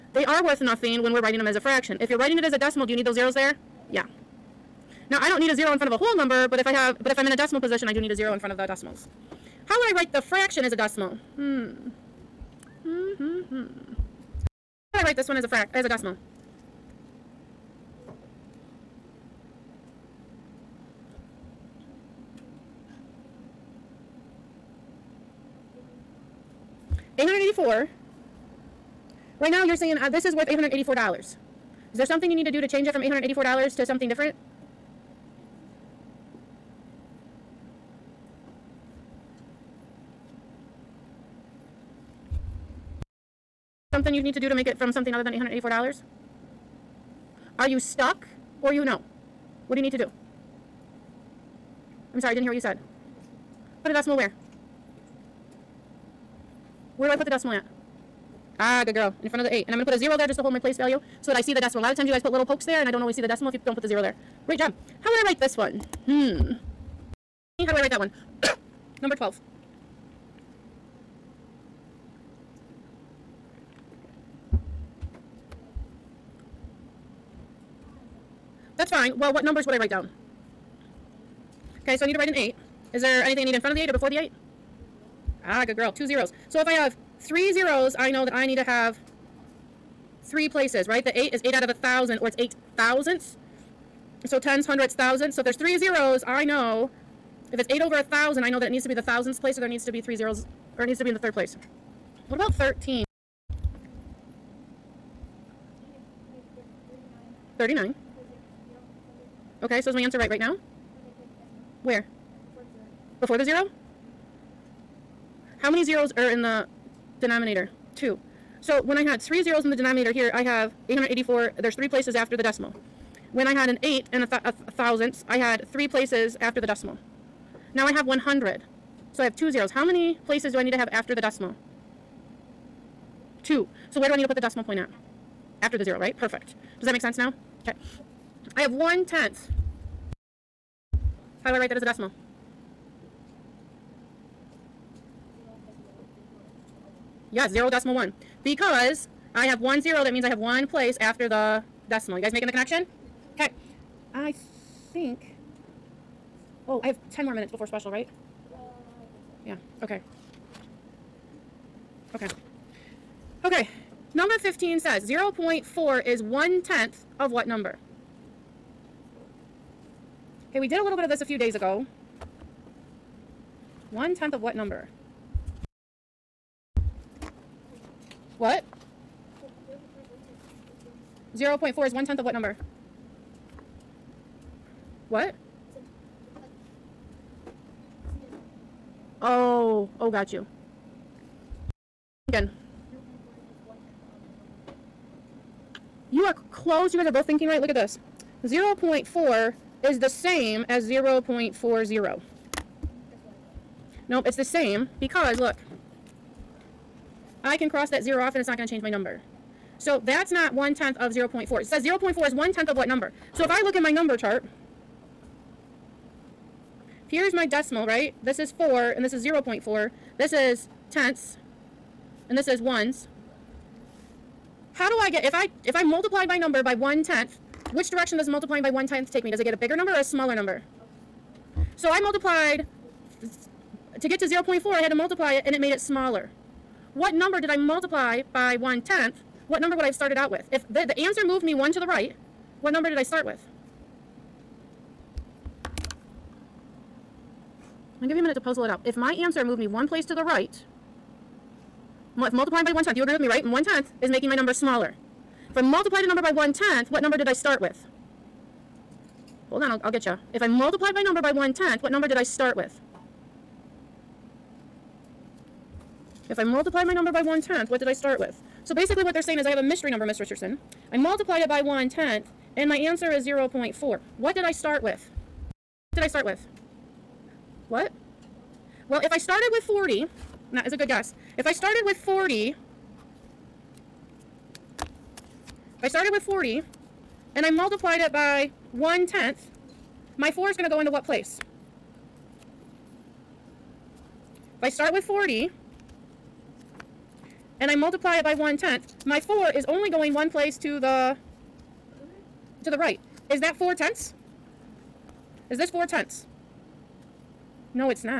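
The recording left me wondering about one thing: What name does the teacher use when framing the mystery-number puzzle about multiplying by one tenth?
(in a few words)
Miss Richardson.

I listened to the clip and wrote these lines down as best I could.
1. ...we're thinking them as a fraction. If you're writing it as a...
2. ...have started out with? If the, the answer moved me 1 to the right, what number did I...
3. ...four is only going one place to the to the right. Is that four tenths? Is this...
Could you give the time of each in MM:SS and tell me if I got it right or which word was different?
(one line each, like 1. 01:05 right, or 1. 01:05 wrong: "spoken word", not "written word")
1. 00:01 wrong: "writing", not "thinking"
2. 03:59 right
3. 04:59 right.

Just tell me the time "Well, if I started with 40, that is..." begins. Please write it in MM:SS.
04:38.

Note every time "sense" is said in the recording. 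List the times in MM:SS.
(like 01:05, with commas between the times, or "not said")
02:17.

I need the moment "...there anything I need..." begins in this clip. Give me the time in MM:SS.
01:23.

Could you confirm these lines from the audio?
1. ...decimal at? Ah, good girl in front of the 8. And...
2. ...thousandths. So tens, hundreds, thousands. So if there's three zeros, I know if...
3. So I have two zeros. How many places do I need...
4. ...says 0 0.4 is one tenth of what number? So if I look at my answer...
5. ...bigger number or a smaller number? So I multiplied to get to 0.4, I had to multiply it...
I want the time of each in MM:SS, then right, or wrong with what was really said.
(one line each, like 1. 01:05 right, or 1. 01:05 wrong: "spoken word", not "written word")
1. 00:57 right
2. 01:32 right
3. 02:09 right
4. 03:31 wrong: "number", not "answer"
5. 03:49 right.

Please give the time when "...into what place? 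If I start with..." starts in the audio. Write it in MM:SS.
04:50.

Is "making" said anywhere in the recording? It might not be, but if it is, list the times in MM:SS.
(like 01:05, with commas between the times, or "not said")
02:32, 04:14.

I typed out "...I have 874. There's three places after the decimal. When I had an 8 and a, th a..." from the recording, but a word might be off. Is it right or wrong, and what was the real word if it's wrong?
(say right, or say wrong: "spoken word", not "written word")
wrong: "884", not "874".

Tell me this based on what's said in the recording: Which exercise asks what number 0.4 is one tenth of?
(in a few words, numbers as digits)
15.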